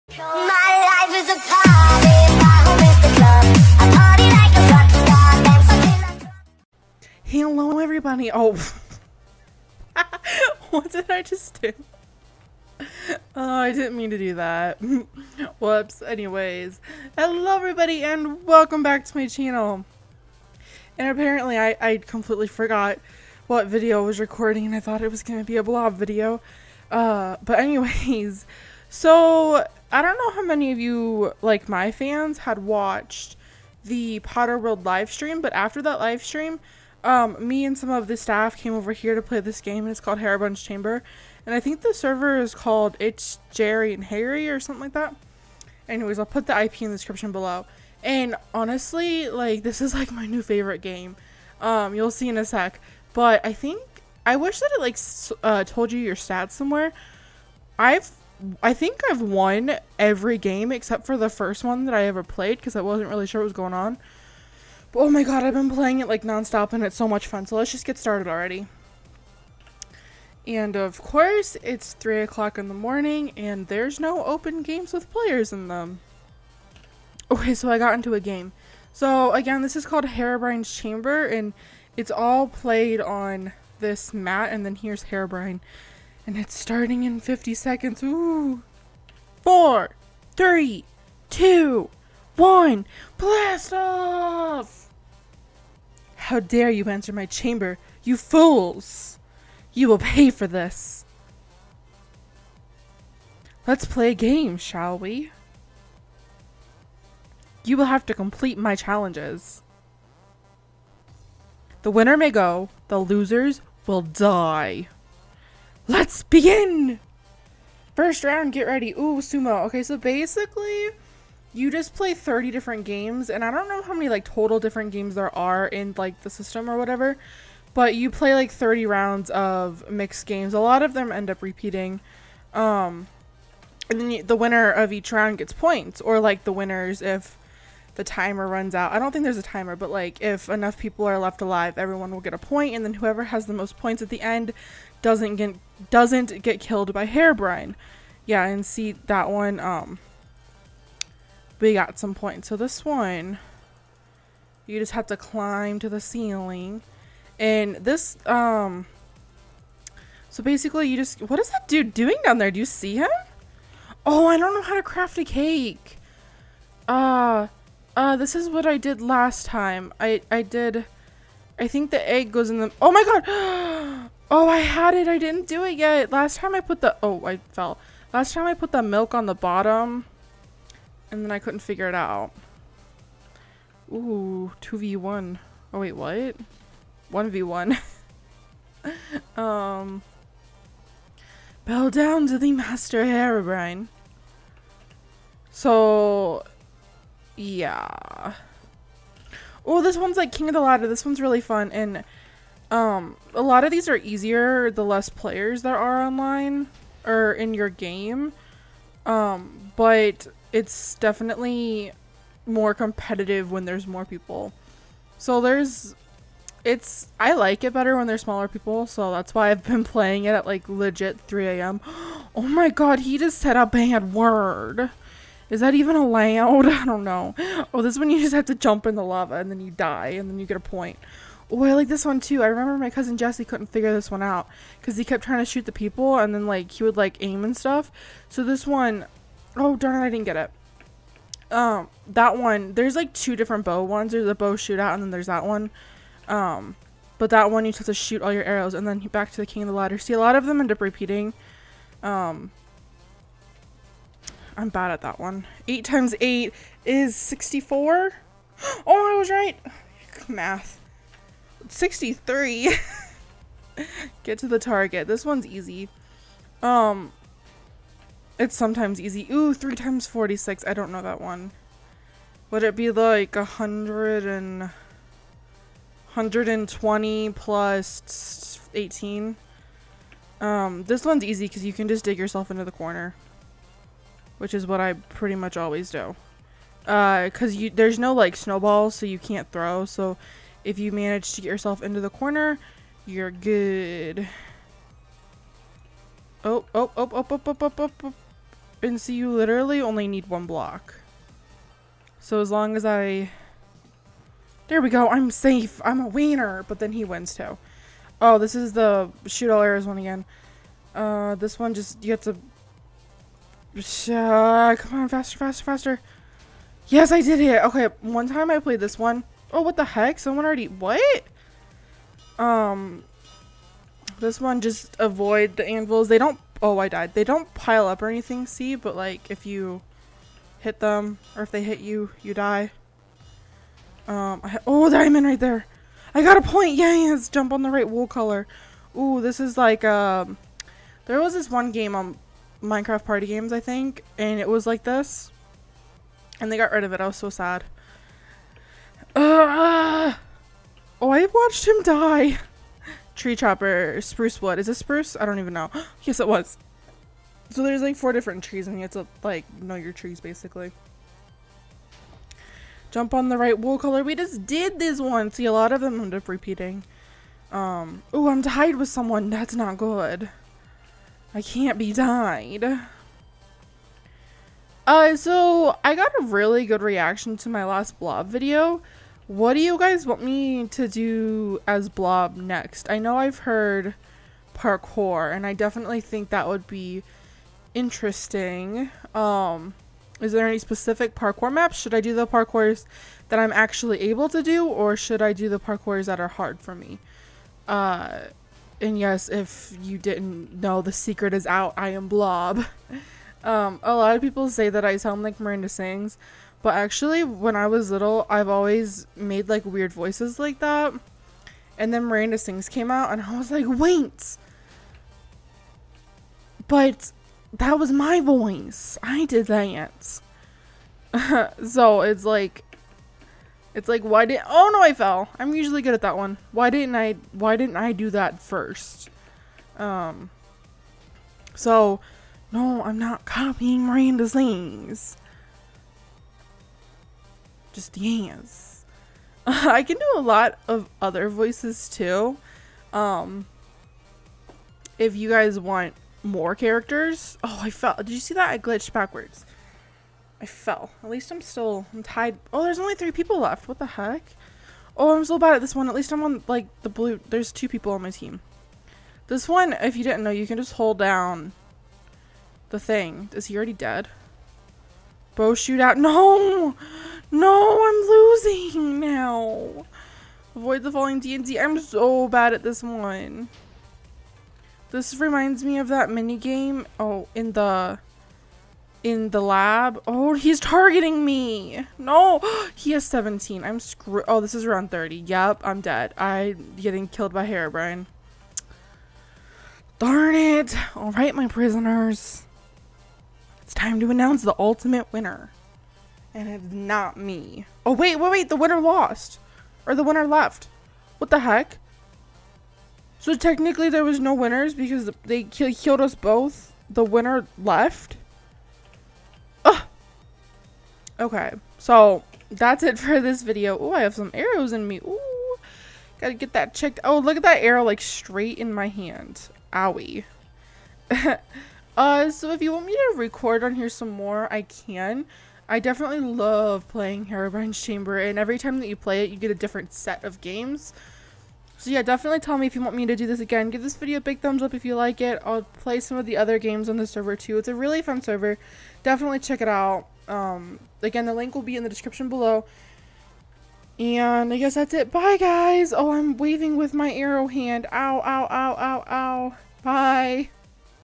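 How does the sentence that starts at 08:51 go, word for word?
So yeah, definitely tell me if you want me to do this again.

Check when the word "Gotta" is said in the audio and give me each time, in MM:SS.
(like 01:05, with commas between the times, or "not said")
08:36.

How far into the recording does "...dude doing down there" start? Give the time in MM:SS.
02:41.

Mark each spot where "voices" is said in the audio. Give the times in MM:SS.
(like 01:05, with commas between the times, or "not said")
06:49, 06:58, 07:21.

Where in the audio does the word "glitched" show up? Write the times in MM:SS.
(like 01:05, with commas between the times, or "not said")
07:28.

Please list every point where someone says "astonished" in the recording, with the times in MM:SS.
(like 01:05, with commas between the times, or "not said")
not said.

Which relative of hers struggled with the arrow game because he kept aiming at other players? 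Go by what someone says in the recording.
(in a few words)
Jesse.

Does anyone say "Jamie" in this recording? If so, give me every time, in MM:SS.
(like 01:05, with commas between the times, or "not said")
not said.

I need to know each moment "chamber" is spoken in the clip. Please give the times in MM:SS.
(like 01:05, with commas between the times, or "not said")
00:40, 01:20, 01:37, 08:47.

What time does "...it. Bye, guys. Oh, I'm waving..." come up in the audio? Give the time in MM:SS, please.
09:04.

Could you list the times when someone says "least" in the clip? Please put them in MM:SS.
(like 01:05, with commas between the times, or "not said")
07:31, 07:35.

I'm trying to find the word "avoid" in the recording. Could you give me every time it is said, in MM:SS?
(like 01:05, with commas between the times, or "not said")
05:24, 07:50.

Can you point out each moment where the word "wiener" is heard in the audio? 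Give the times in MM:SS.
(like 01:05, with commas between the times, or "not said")
05:06.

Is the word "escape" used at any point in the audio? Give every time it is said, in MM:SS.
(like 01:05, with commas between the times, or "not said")
not said.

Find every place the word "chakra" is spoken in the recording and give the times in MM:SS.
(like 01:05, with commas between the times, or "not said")
not said.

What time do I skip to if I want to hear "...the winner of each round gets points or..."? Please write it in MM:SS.
02:14.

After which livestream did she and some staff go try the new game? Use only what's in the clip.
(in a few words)
Potter World.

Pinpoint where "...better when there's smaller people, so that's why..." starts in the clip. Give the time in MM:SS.
03:37.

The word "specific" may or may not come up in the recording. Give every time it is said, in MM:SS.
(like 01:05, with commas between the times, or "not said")
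06:30.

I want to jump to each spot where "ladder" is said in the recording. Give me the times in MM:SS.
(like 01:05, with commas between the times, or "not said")
03:20, 04:09.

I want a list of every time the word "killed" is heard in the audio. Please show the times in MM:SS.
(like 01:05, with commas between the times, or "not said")
02:26, 08:07, 08:25.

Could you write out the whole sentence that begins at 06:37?
Uh, and yes, if you didn't know, the secret is out.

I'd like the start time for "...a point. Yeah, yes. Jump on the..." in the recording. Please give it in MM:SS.
05:36.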